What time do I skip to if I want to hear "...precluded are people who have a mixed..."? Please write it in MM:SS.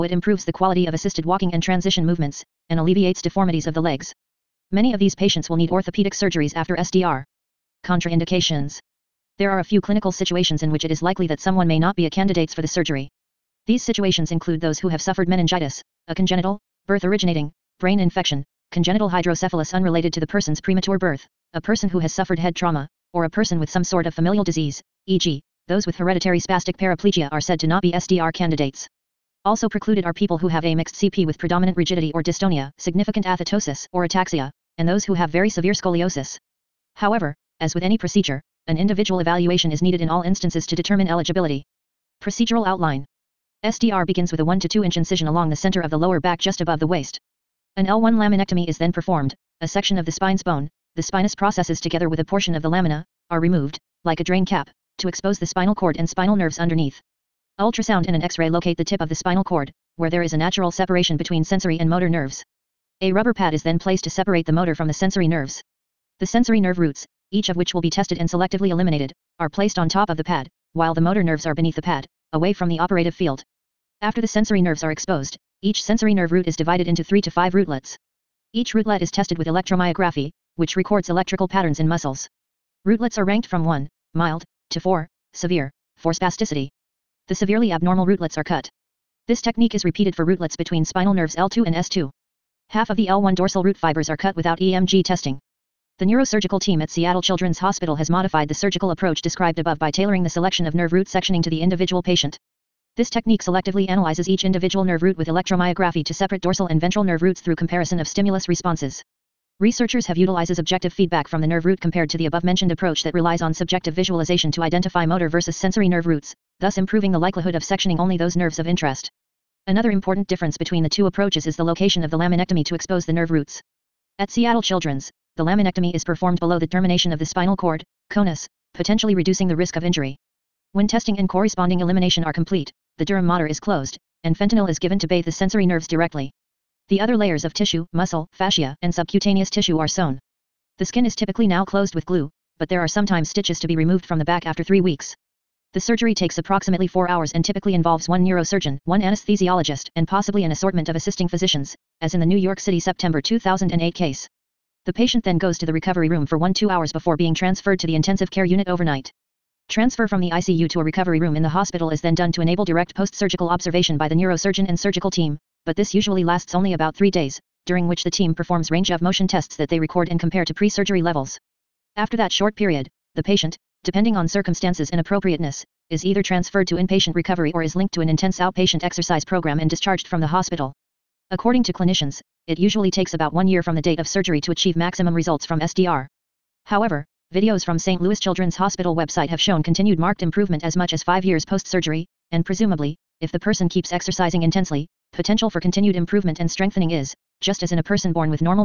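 00:29.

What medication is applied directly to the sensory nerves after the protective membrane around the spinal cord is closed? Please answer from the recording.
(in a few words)
fentanyl.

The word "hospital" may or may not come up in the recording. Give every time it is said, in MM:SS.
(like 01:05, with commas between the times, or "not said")
01:37, 02:41, 03:00, 03:08.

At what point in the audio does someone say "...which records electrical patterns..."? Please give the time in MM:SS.
01:20.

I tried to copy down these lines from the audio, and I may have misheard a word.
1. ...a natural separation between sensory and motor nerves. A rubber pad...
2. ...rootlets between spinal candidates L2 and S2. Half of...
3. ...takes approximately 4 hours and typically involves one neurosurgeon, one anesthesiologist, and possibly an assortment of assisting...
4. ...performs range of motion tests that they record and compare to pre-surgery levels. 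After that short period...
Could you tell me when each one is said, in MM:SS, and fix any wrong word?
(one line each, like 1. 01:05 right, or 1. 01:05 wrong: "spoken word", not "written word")
1. 01:00 right
2. 01:30 wrong: "nerves", not "candidates"
3. 02:26 right
4. 02:48 right.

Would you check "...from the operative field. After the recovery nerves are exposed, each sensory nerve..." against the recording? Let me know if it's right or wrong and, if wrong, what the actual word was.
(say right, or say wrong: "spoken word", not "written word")
wrong: "sensory", not "recovery".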